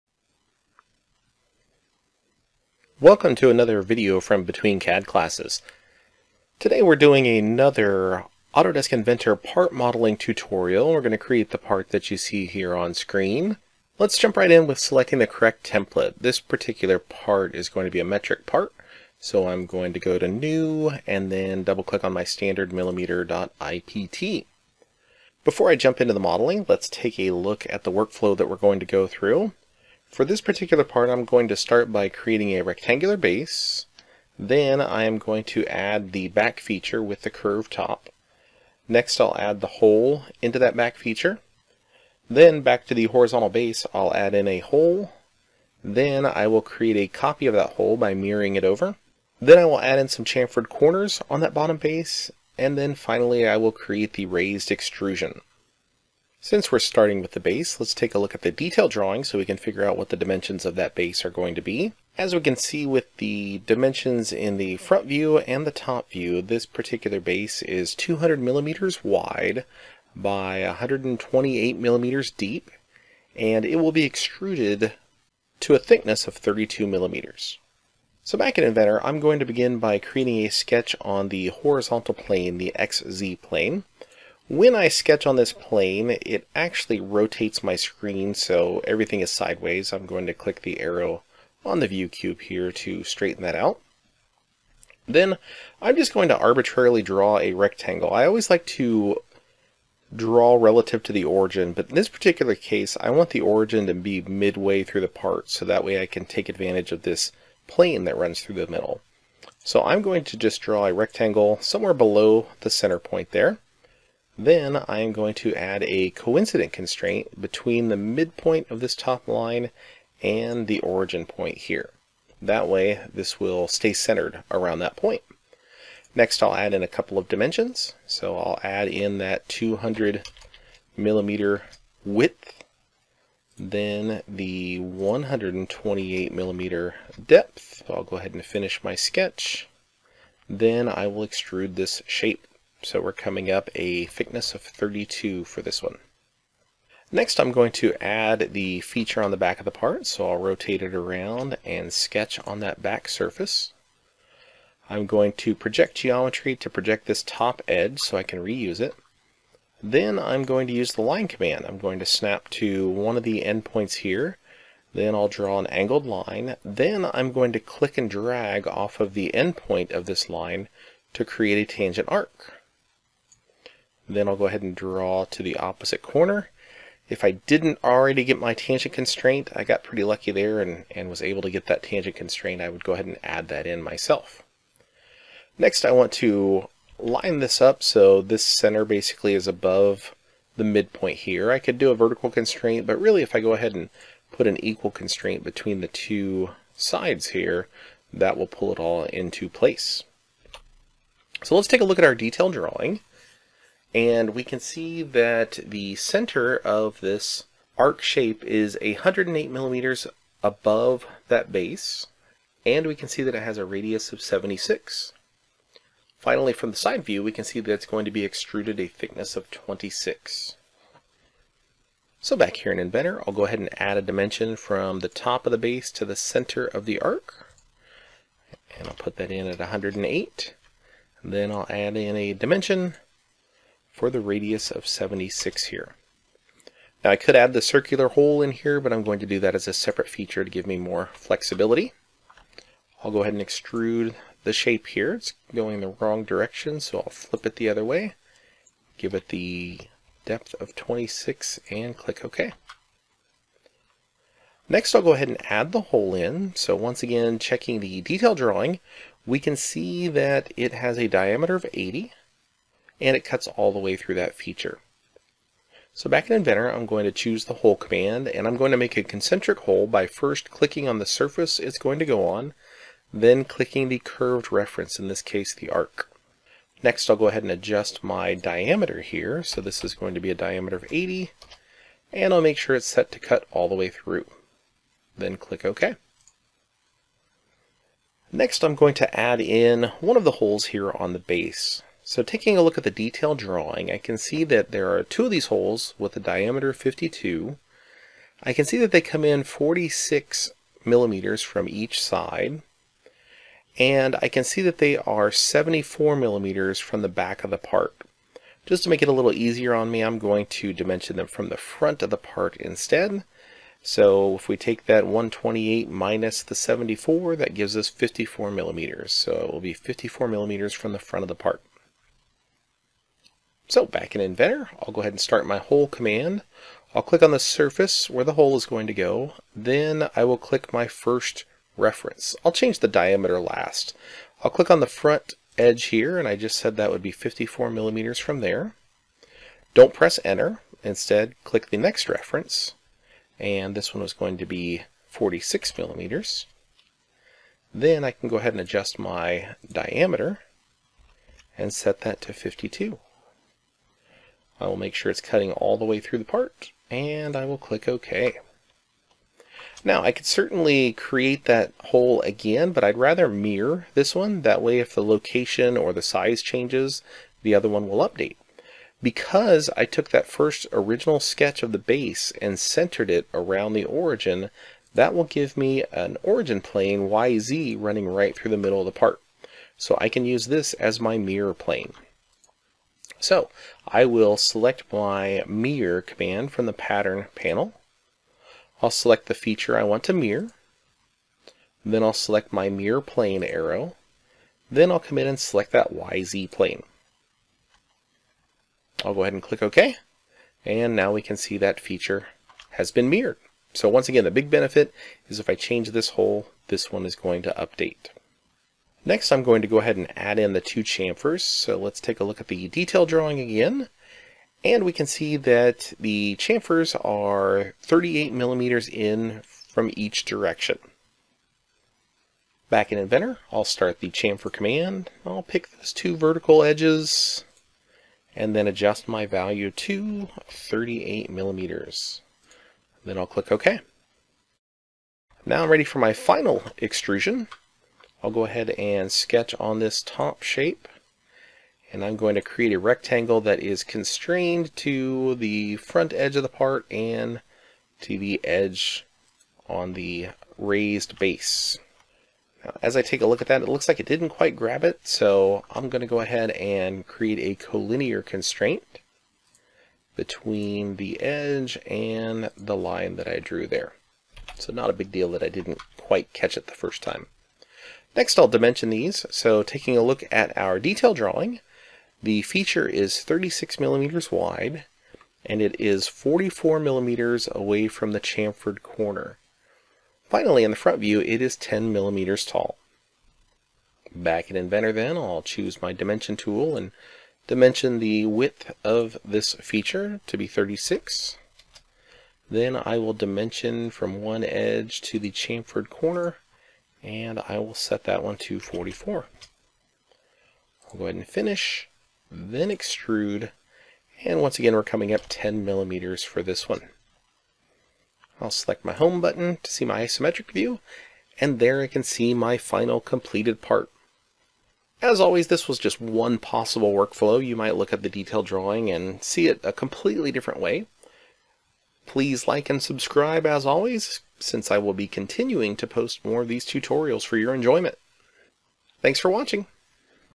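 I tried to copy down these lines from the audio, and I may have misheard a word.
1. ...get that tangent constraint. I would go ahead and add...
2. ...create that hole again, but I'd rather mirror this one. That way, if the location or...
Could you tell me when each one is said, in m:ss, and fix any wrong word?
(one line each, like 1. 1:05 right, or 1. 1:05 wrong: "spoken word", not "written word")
1. 3:01 right
2. 6:00 right.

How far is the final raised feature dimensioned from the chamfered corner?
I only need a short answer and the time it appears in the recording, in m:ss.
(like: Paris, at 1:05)
44 millimeters, at 7:56.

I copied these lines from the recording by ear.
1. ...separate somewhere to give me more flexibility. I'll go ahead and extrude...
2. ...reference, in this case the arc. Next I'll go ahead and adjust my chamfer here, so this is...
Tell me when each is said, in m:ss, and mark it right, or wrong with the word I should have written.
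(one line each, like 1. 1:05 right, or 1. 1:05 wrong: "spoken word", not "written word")
1. 3:59 wrong: "feature", not "somewhere"
2. 4:34 wrong: "diameter", not "chamfer".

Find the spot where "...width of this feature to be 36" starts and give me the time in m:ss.
8:08.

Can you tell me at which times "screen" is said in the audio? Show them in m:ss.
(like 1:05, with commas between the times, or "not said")
0:12, 1:27.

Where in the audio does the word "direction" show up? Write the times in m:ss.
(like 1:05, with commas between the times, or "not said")
4:06, 7:00.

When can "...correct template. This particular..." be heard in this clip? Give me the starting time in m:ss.
0:15.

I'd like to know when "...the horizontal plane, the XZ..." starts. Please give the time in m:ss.
1:21.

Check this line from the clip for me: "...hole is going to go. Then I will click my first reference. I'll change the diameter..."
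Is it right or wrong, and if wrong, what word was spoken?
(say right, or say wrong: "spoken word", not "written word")
right.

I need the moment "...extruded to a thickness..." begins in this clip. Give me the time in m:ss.
1:14.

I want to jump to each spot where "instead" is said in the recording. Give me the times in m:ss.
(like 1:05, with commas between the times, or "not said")
5:12, 5:40.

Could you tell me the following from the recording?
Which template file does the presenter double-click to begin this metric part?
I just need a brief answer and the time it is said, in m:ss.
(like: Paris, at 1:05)
standard millimeter.ipt, at 0:22.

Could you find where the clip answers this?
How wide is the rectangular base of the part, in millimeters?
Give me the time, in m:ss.
1:07.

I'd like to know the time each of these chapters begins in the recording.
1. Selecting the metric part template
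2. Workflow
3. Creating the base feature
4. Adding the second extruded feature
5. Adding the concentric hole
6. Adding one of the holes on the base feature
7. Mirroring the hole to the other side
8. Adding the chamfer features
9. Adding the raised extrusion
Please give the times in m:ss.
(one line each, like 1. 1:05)
1. 0:13
2. 0:25
3. 0:56
4. 2:26
5. 4:14
6. 4:47
7. 5:59
8. 6:48
9. 7:14.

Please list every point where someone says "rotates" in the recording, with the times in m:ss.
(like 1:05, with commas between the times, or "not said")
1:26, 2:30.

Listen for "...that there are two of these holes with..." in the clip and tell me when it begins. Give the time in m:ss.
4:54.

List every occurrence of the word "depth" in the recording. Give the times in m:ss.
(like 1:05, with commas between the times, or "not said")
2:17, 4:10.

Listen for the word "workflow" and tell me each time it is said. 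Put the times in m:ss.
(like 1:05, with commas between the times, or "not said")
0:27, 8:36.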